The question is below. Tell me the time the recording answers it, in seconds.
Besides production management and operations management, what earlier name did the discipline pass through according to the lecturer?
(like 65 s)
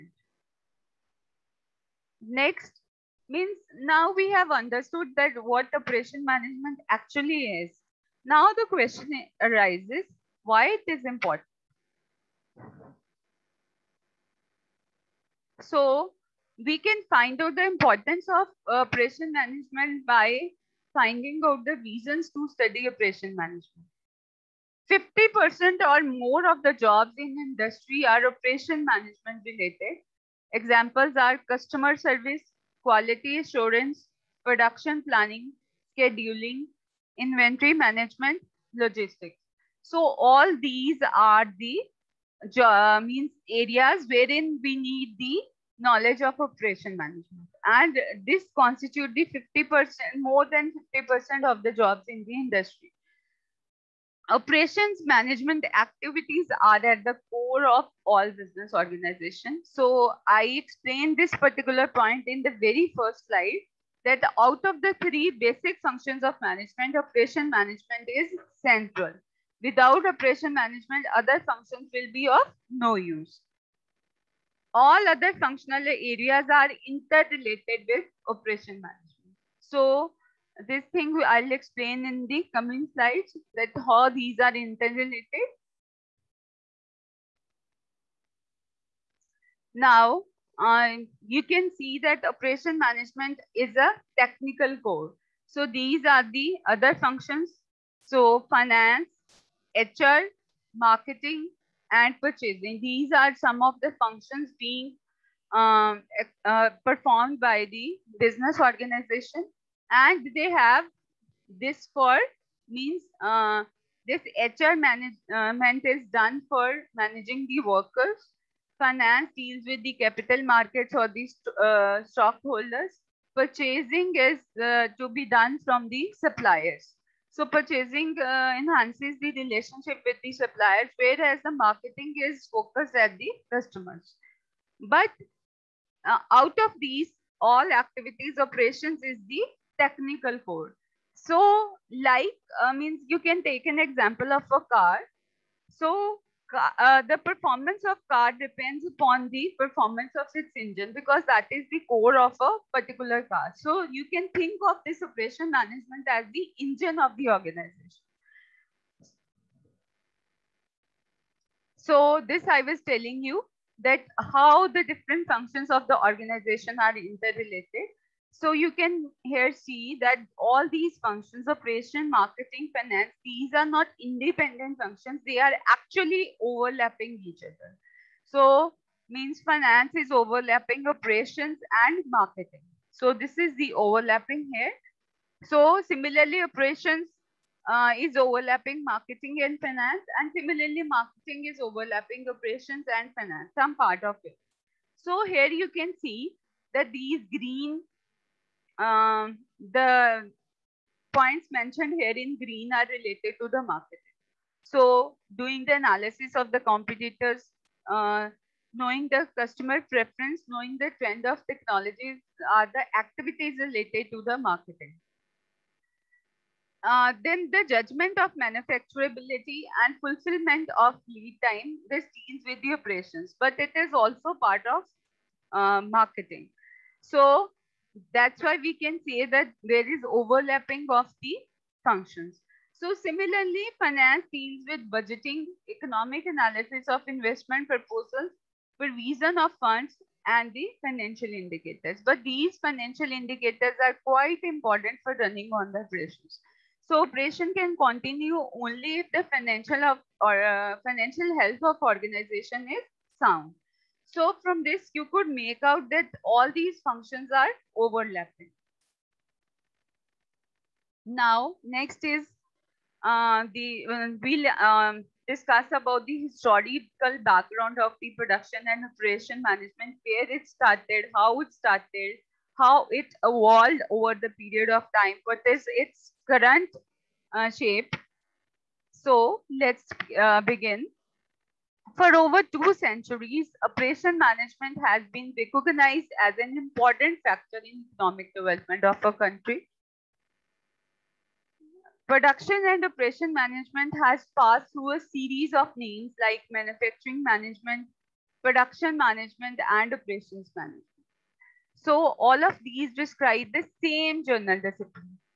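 296 s.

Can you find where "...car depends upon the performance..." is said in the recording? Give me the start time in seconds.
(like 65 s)
148 s.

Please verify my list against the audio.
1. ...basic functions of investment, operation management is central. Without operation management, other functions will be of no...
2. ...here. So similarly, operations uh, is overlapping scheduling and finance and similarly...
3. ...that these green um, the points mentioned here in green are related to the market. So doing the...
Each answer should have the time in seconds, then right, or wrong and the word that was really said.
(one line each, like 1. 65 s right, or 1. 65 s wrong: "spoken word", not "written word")
1. 65 s wrong: "management", not "investment"
2. 184 s wrong: "marketing", not "scheduling"
3. 196 s right.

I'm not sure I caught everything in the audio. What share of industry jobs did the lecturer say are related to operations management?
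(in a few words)
50% or more.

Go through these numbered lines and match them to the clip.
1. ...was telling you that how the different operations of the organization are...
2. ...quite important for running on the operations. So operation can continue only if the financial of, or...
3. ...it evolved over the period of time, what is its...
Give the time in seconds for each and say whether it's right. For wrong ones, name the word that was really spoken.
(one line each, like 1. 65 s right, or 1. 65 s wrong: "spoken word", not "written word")
1. 162 s wrong: "functions", not "operations"
2. 244 s right
3. 272 s right.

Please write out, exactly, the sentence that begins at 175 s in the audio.
They are actually overlapping each other.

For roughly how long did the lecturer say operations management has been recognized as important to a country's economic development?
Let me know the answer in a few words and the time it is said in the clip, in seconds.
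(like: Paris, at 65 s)
over two centuries, at 282 s.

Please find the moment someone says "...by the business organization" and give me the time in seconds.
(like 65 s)
107 s.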